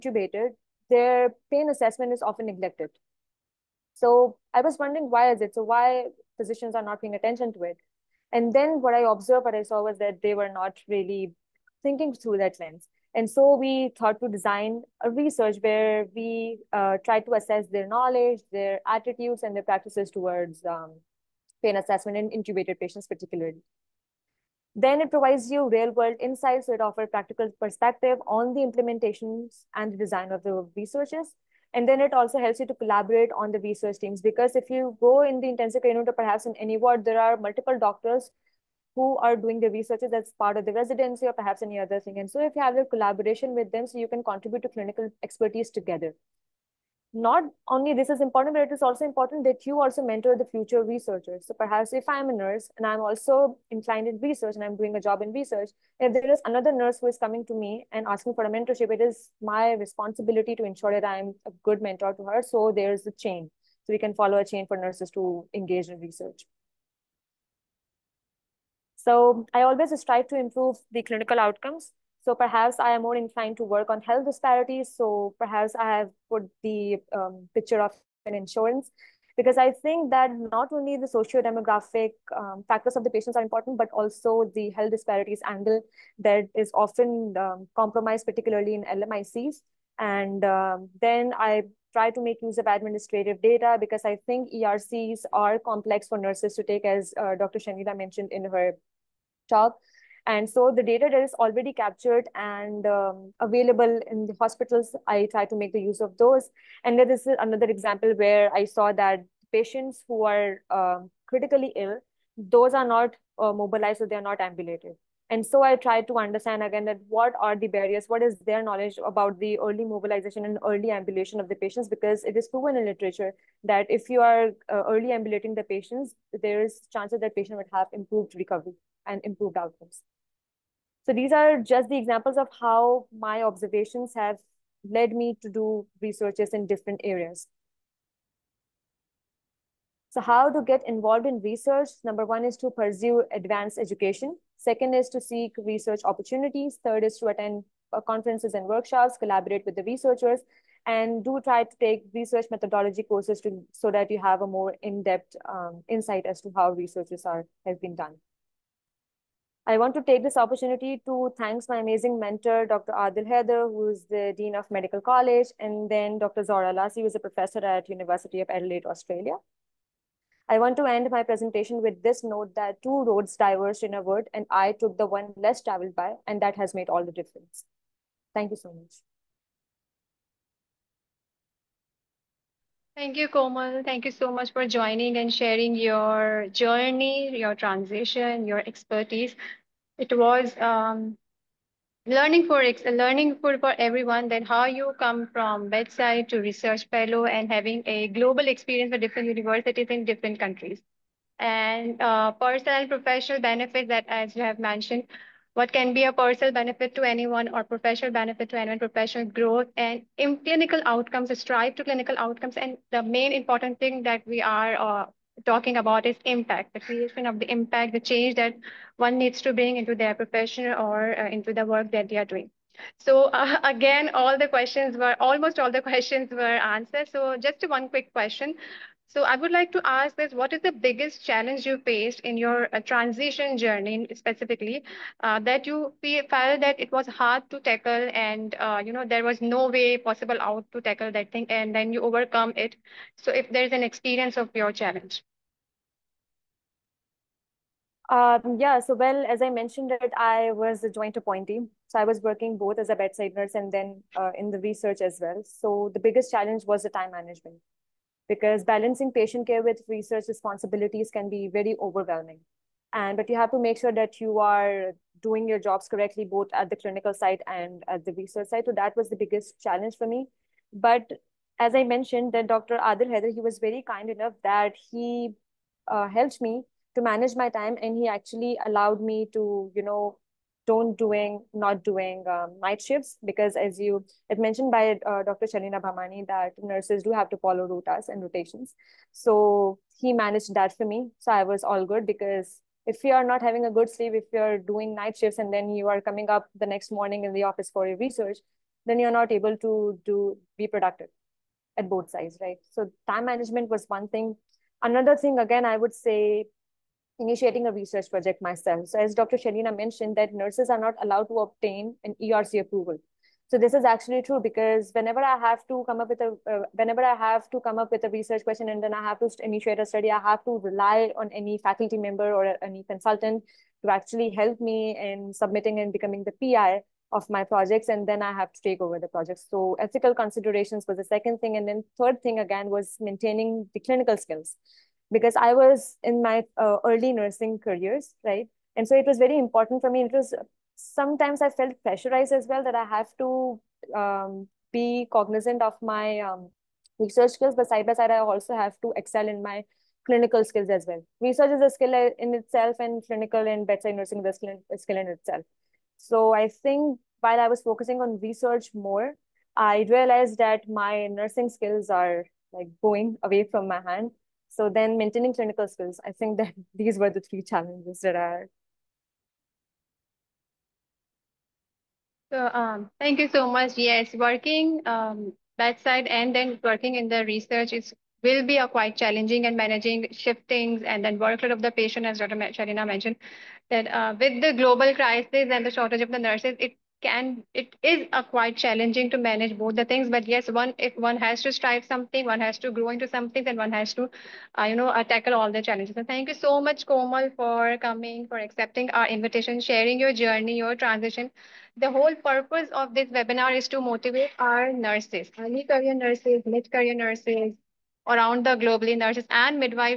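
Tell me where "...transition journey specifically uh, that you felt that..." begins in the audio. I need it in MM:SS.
03:52.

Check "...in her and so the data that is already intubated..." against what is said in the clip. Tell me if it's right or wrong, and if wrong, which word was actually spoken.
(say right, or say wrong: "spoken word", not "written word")
wrong: "captured", not "intubated".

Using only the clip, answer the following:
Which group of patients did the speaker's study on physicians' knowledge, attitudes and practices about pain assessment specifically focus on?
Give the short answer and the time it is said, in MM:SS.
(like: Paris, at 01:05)
Intubated patients, at 00:22.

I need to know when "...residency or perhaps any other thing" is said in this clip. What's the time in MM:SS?
00:40.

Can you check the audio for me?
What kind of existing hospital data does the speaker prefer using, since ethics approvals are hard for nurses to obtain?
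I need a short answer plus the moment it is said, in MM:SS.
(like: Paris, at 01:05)
Administrative data, at 01:32.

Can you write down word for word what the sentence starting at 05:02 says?
So time management was one thing.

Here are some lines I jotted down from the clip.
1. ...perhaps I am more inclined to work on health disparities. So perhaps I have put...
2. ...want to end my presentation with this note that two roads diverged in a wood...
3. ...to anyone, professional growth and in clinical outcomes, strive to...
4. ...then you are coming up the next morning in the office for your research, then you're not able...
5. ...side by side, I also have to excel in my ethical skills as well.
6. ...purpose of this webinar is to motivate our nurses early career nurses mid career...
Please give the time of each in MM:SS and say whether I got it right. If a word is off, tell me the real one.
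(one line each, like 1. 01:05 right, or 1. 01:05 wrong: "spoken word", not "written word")
1. 01:12 right
2. 02:50 right
3. 03:28 right
4. 04:55 right
5. 05:47 wrong: "clinical", not "ethical"
6. 06:42 right.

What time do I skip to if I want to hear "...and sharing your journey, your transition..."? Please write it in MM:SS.
03:05.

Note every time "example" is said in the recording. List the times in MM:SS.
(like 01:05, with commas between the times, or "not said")
01:47, 02:11.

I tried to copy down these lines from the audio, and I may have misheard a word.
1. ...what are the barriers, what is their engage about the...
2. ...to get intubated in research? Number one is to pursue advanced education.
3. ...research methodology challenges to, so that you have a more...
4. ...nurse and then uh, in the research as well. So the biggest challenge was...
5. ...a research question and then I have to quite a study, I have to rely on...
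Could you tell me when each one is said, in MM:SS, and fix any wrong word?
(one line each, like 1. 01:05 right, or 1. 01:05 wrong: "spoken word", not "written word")
1. 01:57 wrong: "knowledge", not "engage"
2. 02:20 wrong: "involved", not "intubated"
3. 02:32 wrong: "courses", not "challenges"
4. 04:13 right
5. 05:18 wrong: "initiate", not "quite".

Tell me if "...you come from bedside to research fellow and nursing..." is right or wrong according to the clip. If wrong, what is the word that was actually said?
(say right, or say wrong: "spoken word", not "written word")
wrong: "having", not "nursing".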